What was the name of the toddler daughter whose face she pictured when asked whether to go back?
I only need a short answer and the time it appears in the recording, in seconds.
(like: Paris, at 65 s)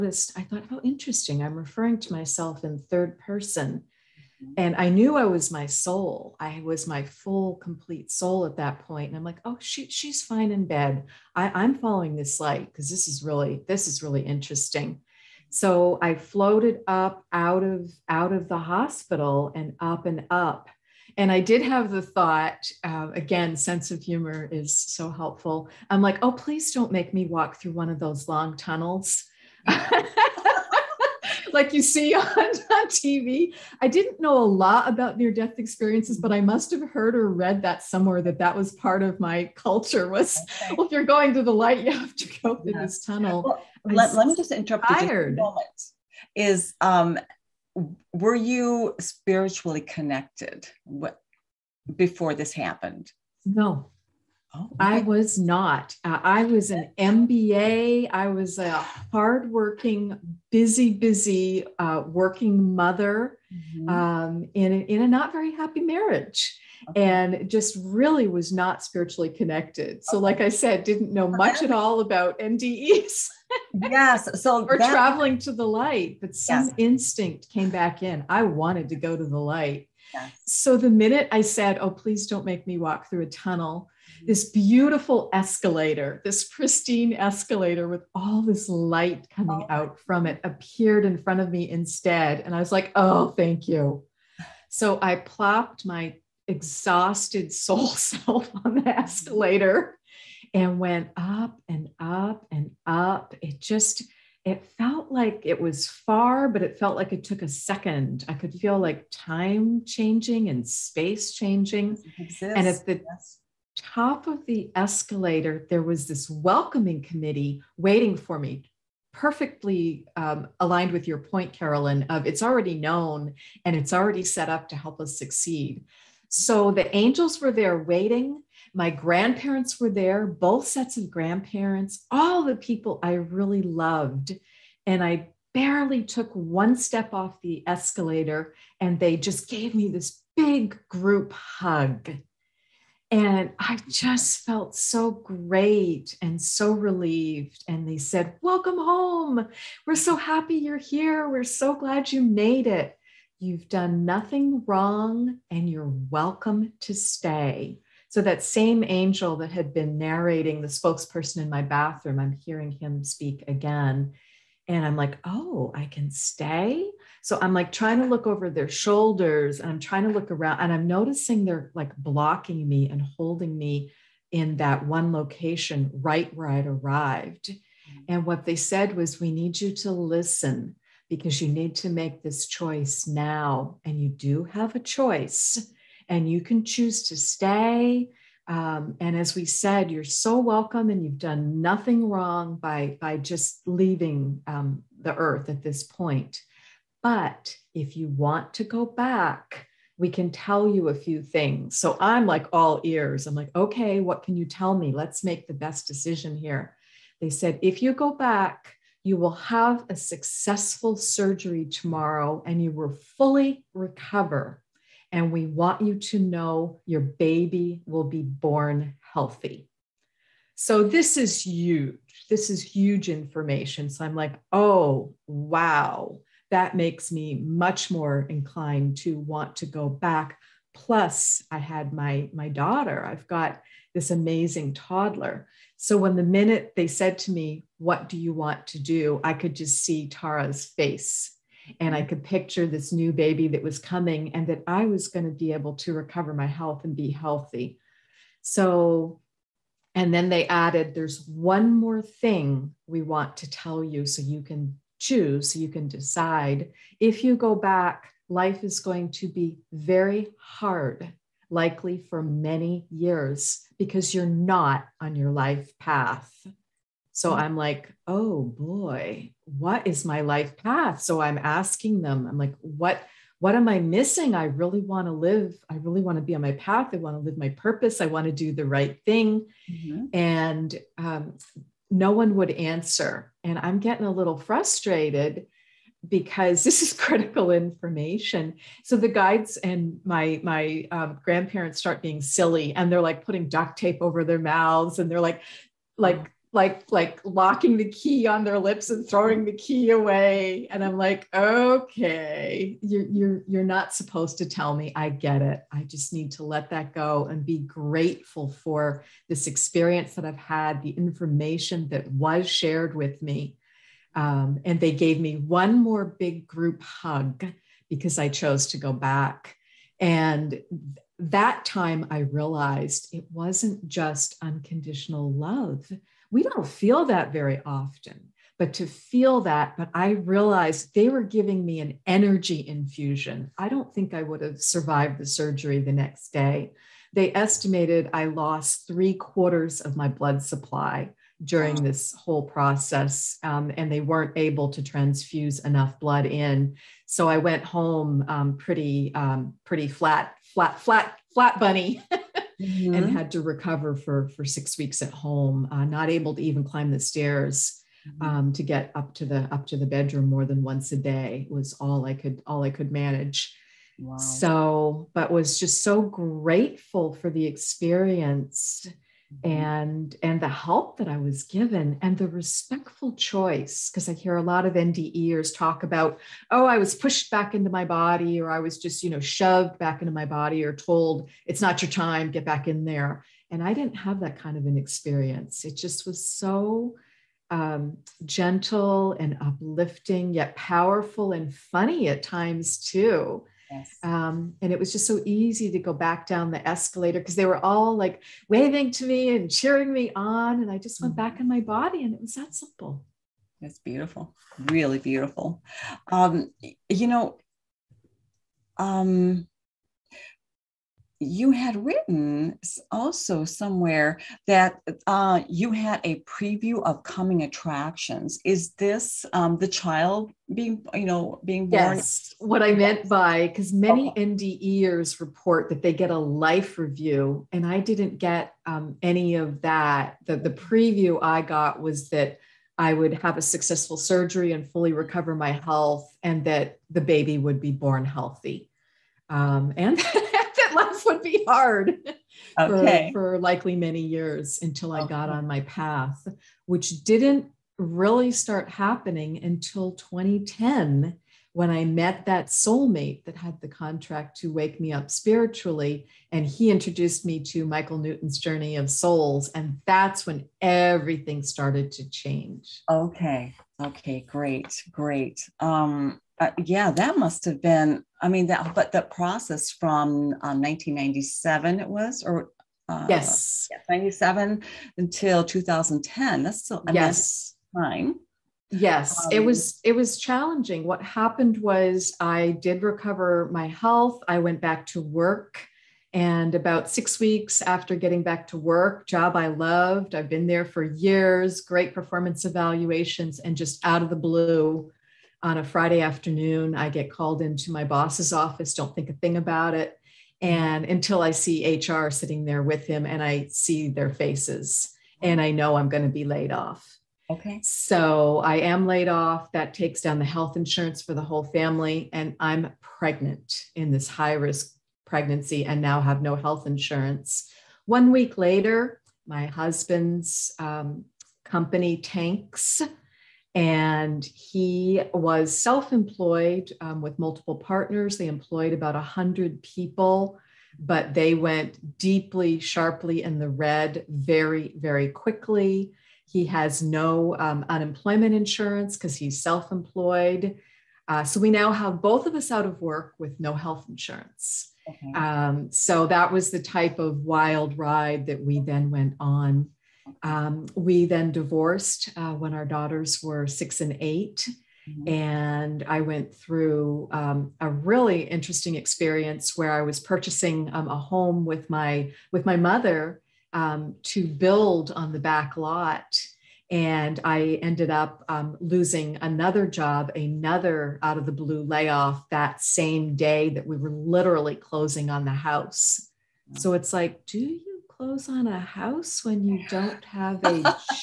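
Tara, at 240 s.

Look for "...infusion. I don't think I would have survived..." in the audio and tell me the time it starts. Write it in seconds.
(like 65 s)
332 s.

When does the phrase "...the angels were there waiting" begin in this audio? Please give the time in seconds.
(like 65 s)
126 s.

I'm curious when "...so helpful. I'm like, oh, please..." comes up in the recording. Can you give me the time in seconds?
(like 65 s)
24 s.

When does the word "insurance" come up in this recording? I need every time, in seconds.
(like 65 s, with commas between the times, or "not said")
510 s, 516 s, 538 s, 543 s.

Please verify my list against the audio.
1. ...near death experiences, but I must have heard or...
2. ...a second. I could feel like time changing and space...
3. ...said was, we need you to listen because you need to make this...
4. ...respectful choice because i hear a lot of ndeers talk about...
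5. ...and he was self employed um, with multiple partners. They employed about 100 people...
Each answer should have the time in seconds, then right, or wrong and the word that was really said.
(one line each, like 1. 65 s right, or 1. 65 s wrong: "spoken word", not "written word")
1. 35 s right
2. 107 s right
3. 178 s right
4. 372 s right
5. 523 s right.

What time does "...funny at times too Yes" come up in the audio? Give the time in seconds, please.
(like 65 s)
391 s.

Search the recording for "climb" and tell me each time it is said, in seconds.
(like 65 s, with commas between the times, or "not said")
356 s.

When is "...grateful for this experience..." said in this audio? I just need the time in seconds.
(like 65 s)
307 s.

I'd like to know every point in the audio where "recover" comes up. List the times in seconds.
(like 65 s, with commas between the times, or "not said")
213 s, 245 s, 353 s, 434 s, 482 s.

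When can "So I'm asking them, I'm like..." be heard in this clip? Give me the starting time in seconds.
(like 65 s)
271 s.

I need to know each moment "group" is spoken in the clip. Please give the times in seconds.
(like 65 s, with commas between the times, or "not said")
140 s, 316 s.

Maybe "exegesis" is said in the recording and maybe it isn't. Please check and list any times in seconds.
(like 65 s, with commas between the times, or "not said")
not said.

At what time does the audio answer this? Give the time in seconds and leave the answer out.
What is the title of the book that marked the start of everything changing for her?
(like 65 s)
458 s.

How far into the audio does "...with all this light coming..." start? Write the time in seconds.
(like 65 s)
87 s.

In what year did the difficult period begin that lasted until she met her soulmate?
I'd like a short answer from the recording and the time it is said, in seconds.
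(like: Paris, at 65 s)
1997, at 470 s.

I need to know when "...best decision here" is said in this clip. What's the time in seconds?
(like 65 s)
205 s.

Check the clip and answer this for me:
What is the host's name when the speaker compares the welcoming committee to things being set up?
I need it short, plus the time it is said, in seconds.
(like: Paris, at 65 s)
Carolyn, at 121 s.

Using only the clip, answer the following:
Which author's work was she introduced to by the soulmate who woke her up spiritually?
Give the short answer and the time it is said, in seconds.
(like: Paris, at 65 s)
Michael Newton, at 457 s.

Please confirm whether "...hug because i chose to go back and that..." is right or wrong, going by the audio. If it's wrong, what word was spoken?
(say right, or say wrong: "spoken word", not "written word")
right.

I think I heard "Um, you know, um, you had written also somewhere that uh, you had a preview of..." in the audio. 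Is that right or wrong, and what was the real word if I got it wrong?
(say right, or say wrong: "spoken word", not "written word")
right.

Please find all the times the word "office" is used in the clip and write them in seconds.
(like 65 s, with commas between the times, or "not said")
498 s.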